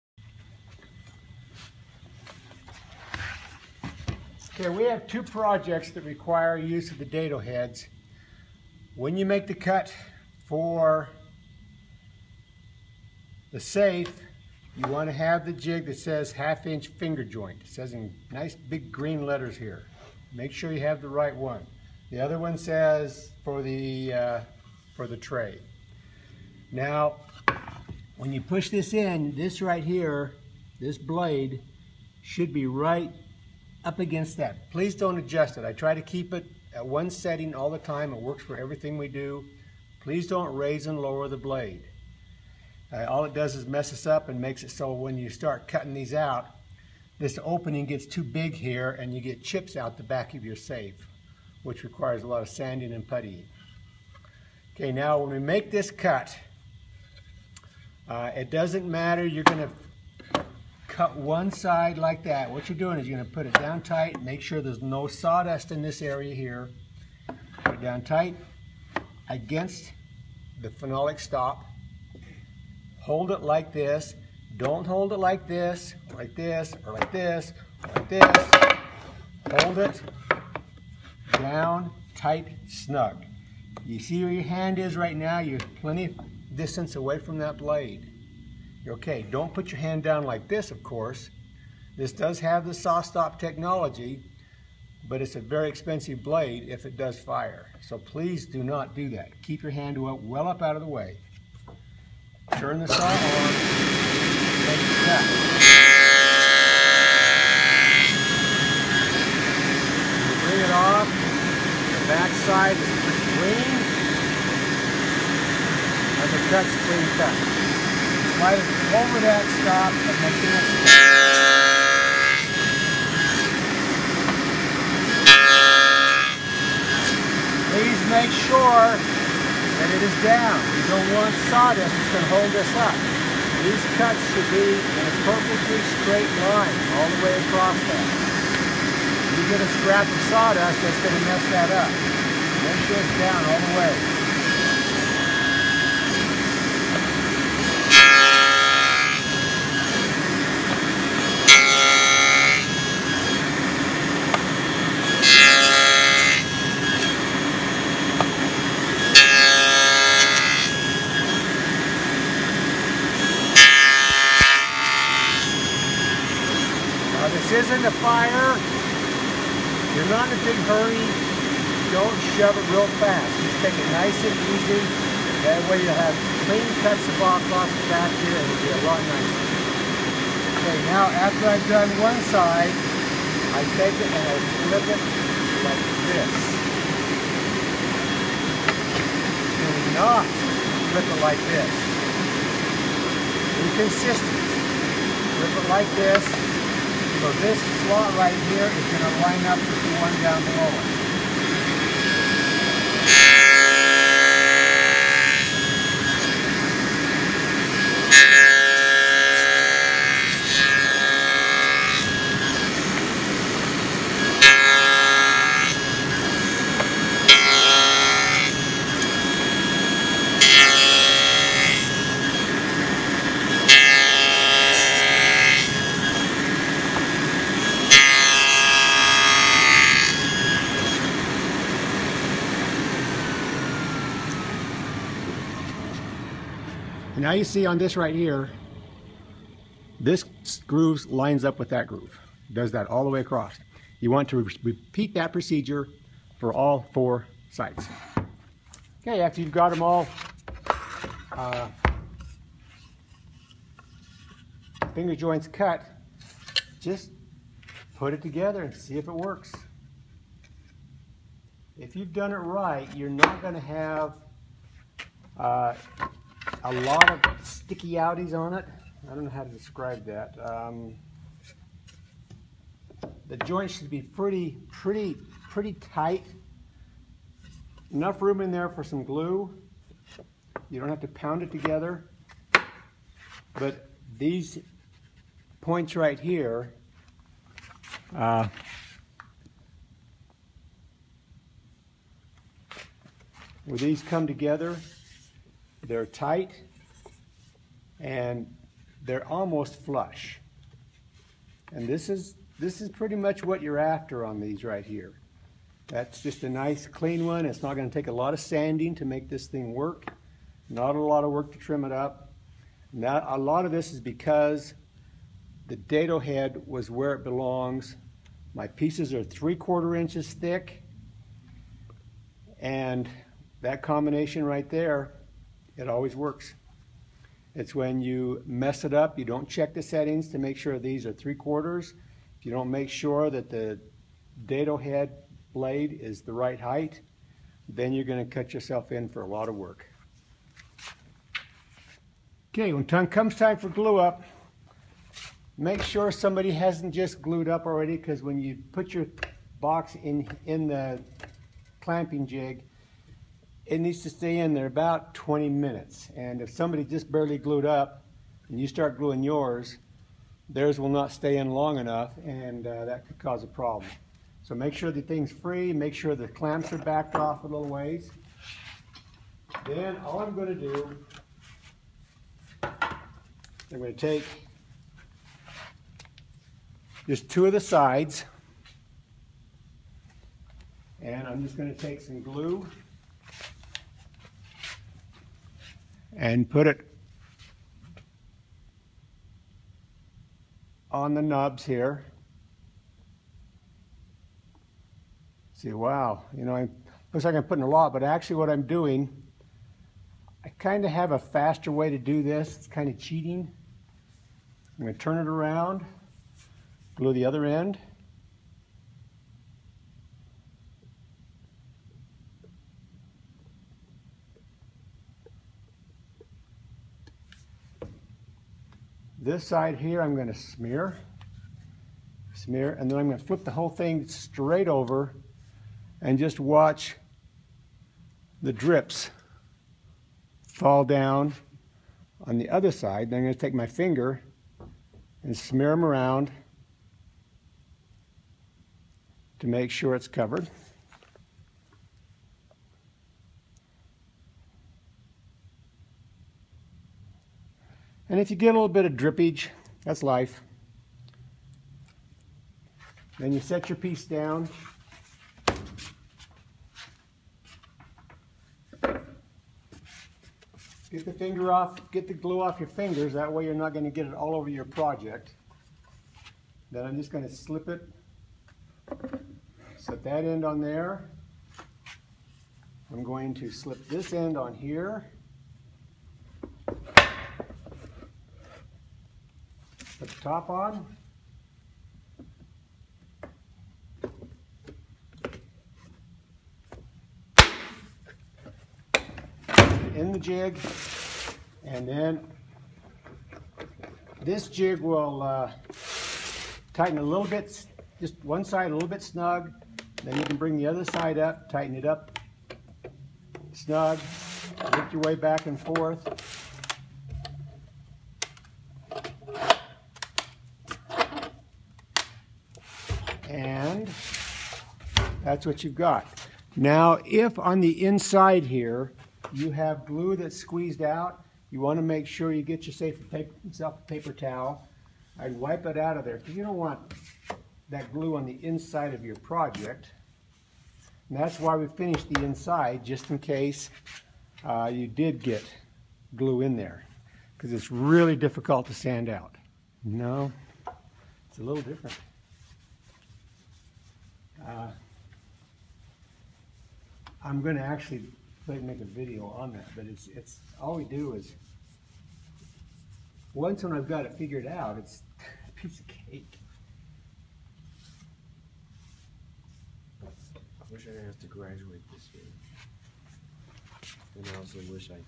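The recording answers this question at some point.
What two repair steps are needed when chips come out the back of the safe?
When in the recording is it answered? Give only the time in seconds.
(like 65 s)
52 s.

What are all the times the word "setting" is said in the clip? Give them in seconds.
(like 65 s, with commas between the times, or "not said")
37 s, 329 s.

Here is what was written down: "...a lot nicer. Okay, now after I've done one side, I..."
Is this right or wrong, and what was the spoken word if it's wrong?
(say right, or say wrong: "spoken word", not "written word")
right.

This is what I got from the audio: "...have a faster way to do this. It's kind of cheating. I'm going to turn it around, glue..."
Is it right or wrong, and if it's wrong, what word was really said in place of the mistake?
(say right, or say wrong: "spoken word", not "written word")
right.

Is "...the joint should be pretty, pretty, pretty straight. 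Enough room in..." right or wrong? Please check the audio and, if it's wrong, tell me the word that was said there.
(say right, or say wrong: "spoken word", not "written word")
wrong: "tight", not "straight".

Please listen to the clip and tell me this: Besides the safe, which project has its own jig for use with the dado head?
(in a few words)
The tray.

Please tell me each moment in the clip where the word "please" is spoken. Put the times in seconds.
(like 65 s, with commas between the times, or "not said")
34 s, 40 s, 97 s, 127 s.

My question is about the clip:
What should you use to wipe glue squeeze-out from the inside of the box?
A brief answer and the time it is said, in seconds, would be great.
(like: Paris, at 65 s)
Paper towel, at 523 s.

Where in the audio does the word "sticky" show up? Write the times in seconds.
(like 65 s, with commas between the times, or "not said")
267 s.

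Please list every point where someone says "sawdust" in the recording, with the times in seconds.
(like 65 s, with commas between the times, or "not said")
65 s, 131 s, 140 s.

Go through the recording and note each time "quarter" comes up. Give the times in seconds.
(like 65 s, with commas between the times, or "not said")
319 s, 331 s.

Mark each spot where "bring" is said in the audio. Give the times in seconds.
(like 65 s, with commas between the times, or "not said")
103 s, 500 s.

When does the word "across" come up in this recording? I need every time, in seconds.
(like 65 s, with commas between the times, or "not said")
137 s, 243 s.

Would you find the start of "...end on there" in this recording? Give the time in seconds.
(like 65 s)
470 s.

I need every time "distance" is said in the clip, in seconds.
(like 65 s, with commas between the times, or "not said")
86 s.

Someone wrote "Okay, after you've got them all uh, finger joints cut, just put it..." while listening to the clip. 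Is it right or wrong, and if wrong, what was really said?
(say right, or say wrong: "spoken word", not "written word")
right.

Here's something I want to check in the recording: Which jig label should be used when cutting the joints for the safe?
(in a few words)
Half inch finger joint.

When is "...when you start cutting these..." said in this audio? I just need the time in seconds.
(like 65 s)
44 s.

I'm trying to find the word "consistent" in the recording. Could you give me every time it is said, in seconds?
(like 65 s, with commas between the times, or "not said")
193 s.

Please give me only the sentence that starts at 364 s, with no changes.
So make sure the thing's free, make sure the clamps are backed off a little ways.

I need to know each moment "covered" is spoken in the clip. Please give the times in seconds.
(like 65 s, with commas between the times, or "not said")
440 s.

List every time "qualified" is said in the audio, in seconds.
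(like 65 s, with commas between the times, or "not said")
not said.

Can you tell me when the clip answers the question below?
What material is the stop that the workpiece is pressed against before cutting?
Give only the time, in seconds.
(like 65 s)
70 s.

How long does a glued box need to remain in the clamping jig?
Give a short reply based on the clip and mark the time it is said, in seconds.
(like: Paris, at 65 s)
20 minutes, at 355 s.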